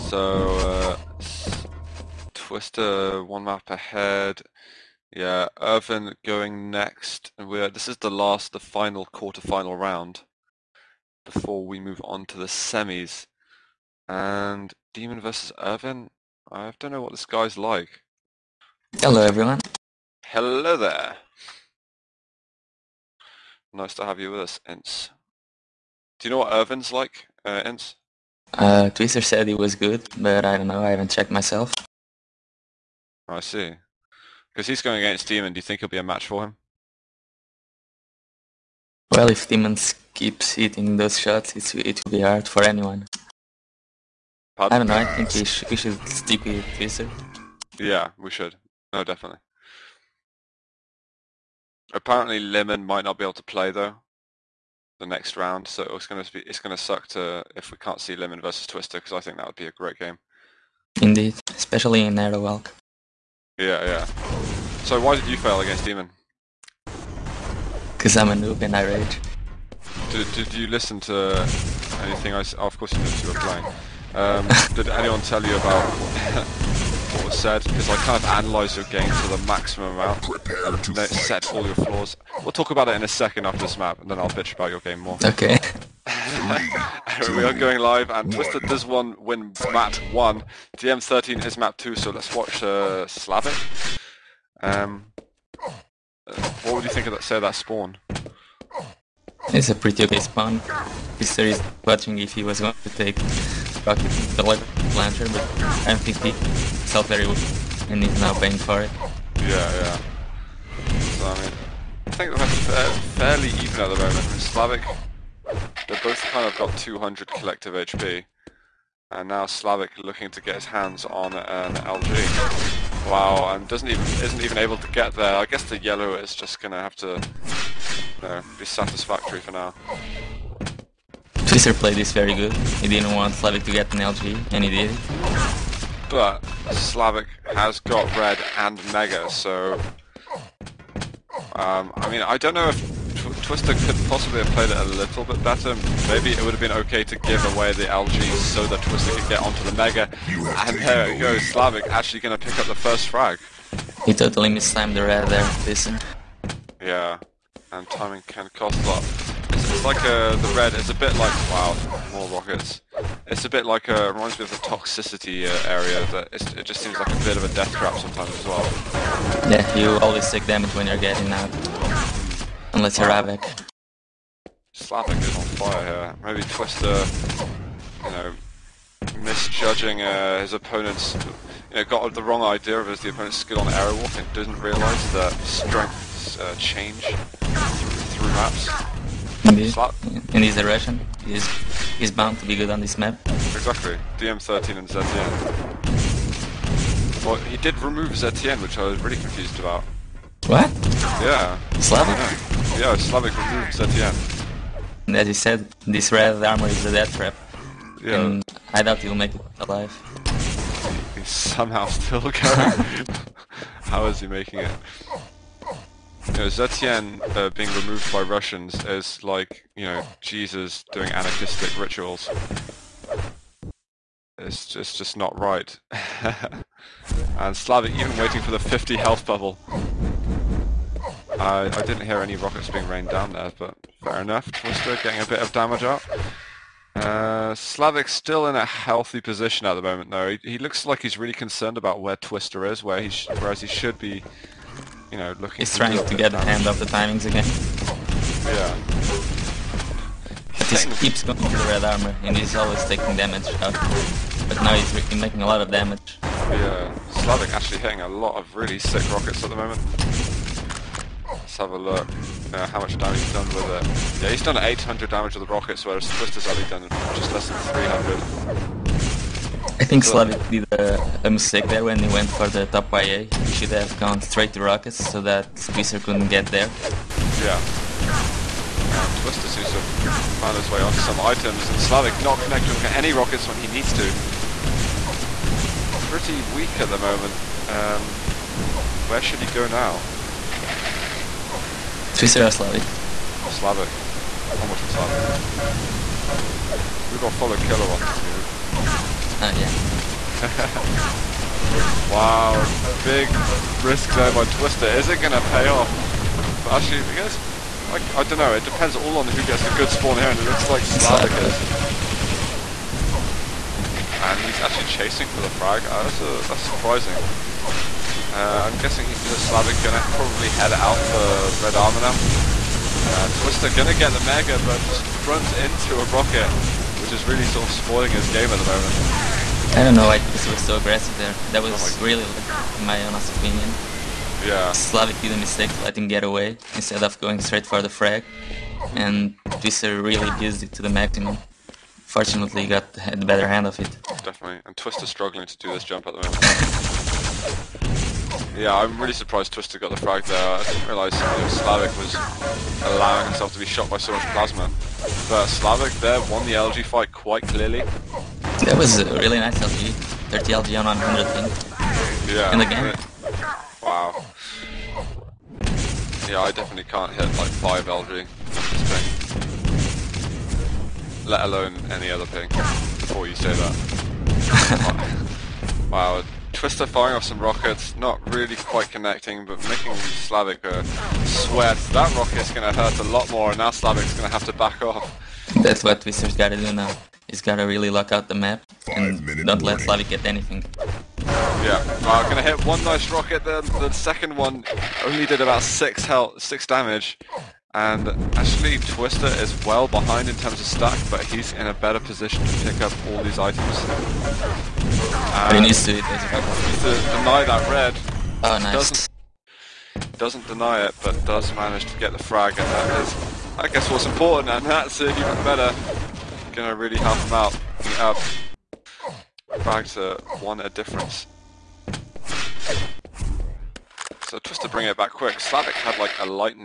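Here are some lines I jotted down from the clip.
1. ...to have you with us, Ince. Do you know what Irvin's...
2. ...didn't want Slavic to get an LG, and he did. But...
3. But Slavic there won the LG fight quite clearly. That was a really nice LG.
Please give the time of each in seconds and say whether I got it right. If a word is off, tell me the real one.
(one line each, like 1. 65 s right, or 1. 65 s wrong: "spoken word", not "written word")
1. 23 s right
2. 132 s right
3. 355 s right.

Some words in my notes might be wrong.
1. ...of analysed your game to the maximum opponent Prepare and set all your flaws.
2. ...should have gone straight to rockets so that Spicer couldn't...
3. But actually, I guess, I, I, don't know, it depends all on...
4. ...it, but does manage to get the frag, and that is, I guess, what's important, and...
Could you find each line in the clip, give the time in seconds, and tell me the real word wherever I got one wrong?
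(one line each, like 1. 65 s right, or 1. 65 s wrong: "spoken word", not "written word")
1. 78 s wrong: "amount", not "opponent"
2. 273 s right
3. 306 s right
4. 410 s right.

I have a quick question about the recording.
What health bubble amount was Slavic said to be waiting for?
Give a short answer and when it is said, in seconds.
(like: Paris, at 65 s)
50, at 228 s.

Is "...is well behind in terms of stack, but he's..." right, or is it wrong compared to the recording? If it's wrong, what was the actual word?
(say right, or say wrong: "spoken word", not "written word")
right.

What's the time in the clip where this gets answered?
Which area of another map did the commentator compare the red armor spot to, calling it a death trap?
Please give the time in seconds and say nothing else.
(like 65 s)
164 s.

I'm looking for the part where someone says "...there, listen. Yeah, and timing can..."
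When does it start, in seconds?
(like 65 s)
155 s.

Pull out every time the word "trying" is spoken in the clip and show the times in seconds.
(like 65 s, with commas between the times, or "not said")
245 s.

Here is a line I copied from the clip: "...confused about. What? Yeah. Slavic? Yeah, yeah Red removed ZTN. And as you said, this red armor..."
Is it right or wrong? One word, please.
wrong.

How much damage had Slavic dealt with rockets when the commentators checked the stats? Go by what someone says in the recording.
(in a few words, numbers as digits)
800.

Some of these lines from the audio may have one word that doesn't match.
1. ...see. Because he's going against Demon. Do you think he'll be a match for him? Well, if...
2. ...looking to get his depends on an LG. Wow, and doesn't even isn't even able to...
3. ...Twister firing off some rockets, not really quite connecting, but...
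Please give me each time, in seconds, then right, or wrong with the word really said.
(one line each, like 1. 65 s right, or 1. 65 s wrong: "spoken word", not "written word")
1. 33 s right
2. 120 s wrong: "hands", not "depends"
3. 376 s right.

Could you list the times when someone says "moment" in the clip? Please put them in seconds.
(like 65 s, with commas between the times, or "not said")
113 s, 239 s, 259 s, 286 s, 328 s, 346 s.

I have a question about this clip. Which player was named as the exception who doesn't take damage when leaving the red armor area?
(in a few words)
Ravik.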